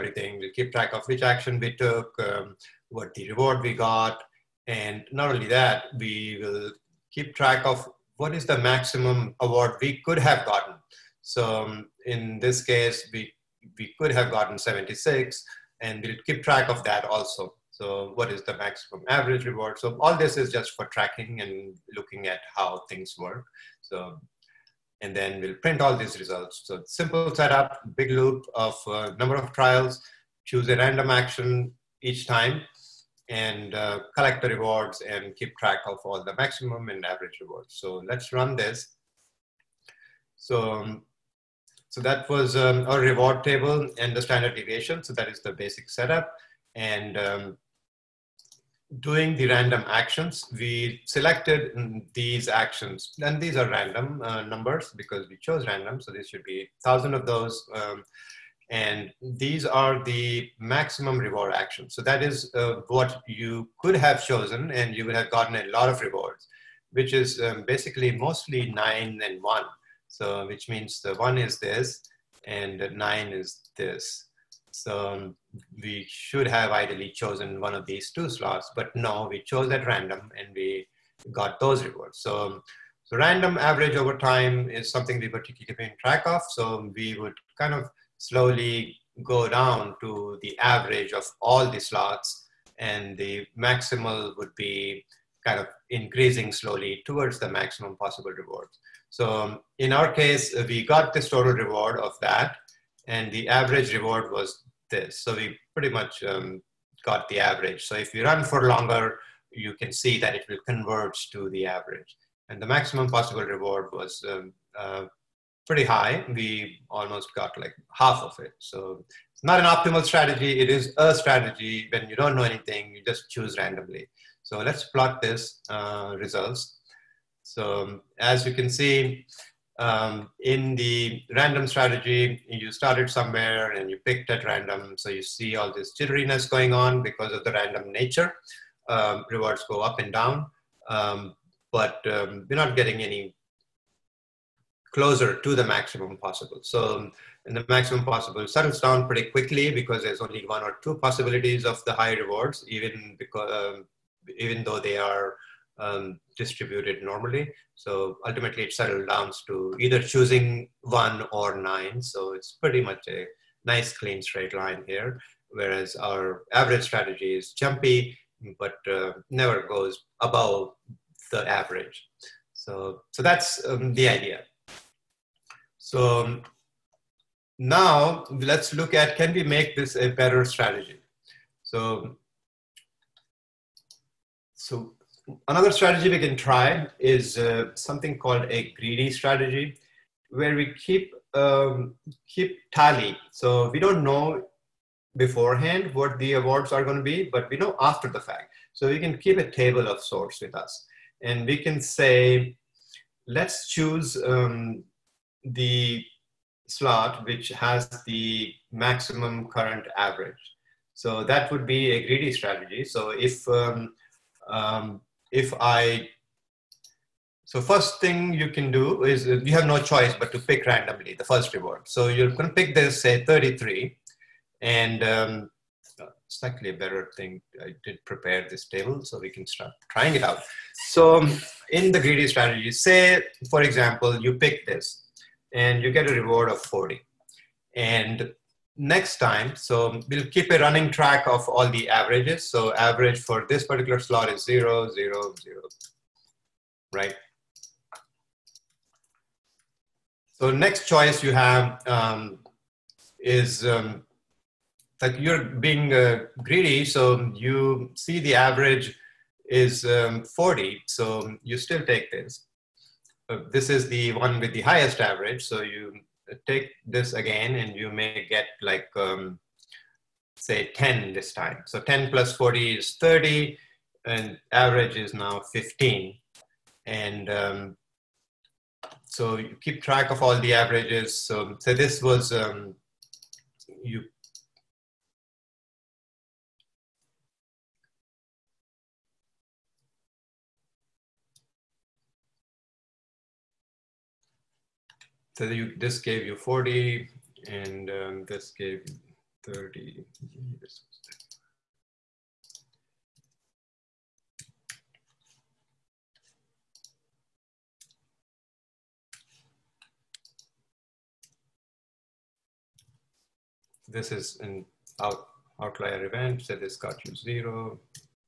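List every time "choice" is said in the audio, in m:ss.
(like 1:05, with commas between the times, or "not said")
3:39, 4:10.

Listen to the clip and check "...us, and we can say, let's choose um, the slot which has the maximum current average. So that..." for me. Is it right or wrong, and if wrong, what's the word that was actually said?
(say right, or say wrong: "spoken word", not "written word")
right.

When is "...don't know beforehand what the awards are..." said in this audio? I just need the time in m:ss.
3:13.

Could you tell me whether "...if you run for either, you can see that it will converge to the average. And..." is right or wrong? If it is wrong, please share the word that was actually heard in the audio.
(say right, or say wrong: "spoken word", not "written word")
wrong: "longer", not "either".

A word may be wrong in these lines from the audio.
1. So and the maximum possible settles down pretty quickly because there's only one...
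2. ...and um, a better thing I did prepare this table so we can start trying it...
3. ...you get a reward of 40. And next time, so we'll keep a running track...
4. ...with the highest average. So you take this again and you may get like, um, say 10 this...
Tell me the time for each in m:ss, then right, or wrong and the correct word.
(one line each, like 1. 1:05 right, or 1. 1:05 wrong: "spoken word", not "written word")
1. 2:26 right
2. 3:44 right
3. 3:55 right
4. 4:24 right.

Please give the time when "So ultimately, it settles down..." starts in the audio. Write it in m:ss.
2:37.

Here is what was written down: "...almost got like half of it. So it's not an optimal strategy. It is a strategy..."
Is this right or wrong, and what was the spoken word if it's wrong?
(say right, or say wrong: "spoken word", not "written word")
right.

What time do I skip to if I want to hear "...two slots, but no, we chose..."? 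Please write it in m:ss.
1:18.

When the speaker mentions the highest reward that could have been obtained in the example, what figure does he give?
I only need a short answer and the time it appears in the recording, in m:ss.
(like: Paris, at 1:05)
76, at 0:14.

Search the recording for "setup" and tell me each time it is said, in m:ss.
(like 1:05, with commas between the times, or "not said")
0:27, 0:45.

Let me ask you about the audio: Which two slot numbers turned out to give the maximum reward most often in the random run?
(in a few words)
9 and 1.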